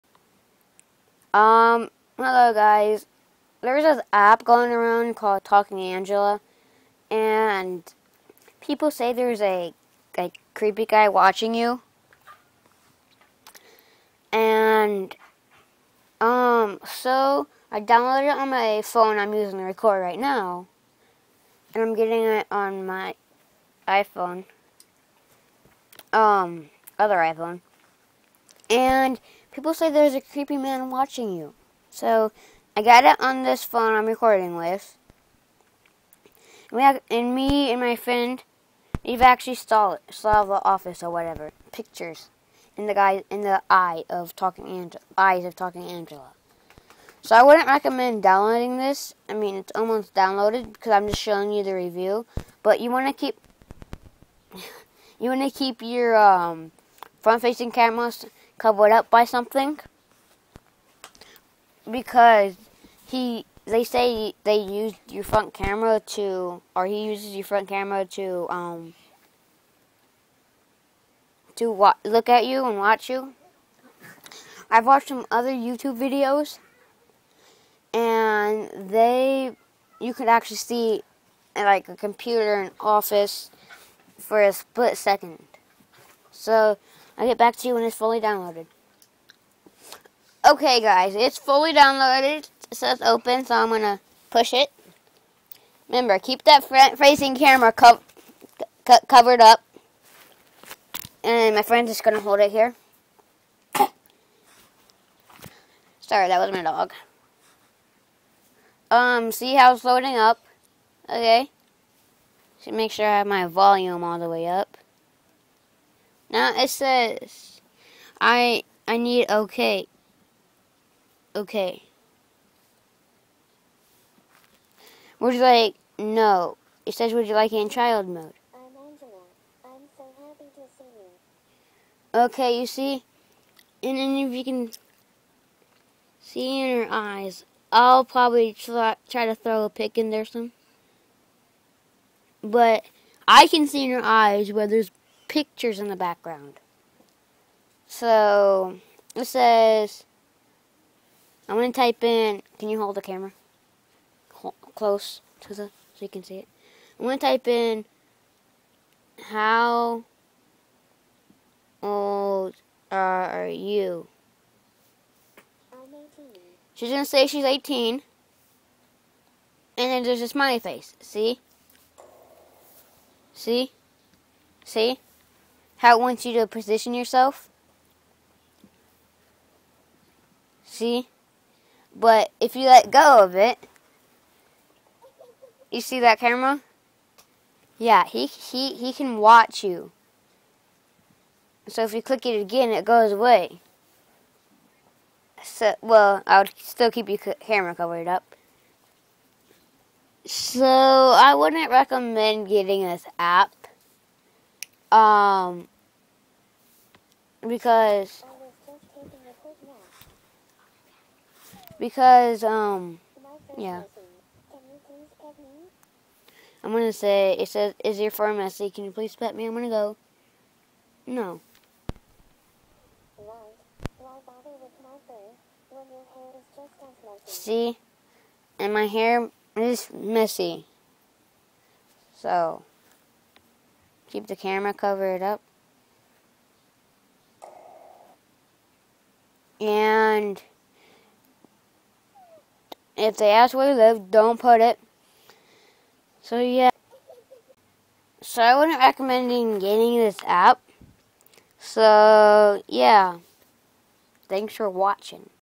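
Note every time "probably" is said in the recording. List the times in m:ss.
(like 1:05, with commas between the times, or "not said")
2:18.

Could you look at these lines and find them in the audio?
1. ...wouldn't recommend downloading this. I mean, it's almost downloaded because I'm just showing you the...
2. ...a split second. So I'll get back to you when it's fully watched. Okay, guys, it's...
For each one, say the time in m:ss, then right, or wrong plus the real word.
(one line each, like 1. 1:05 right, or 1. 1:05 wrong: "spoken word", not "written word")
1. 0:47 right
2. 1:24 wrong: "downloaded", not "watched".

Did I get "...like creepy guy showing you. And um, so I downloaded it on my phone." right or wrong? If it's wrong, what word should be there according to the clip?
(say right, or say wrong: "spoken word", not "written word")
wrong: "watching", not "showing".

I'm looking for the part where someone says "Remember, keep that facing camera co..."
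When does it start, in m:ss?
1:35.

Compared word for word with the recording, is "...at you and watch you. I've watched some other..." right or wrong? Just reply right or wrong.
right.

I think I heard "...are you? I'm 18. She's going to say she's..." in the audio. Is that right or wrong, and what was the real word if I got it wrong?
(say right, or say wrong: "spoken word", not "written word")
right.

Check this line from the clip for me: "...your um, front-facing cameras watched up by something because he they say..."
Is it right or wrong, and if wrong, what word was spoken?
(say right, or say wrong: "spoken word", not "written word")
wrong: "covered", not "watched".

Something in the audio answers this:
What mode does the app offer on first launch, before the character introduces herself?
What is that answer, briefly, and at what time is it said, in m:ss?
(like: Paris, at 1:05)
child mode, at 2:07.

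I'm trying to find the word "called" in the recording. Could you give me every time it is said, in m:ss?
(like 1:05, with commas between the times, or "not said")
0:05.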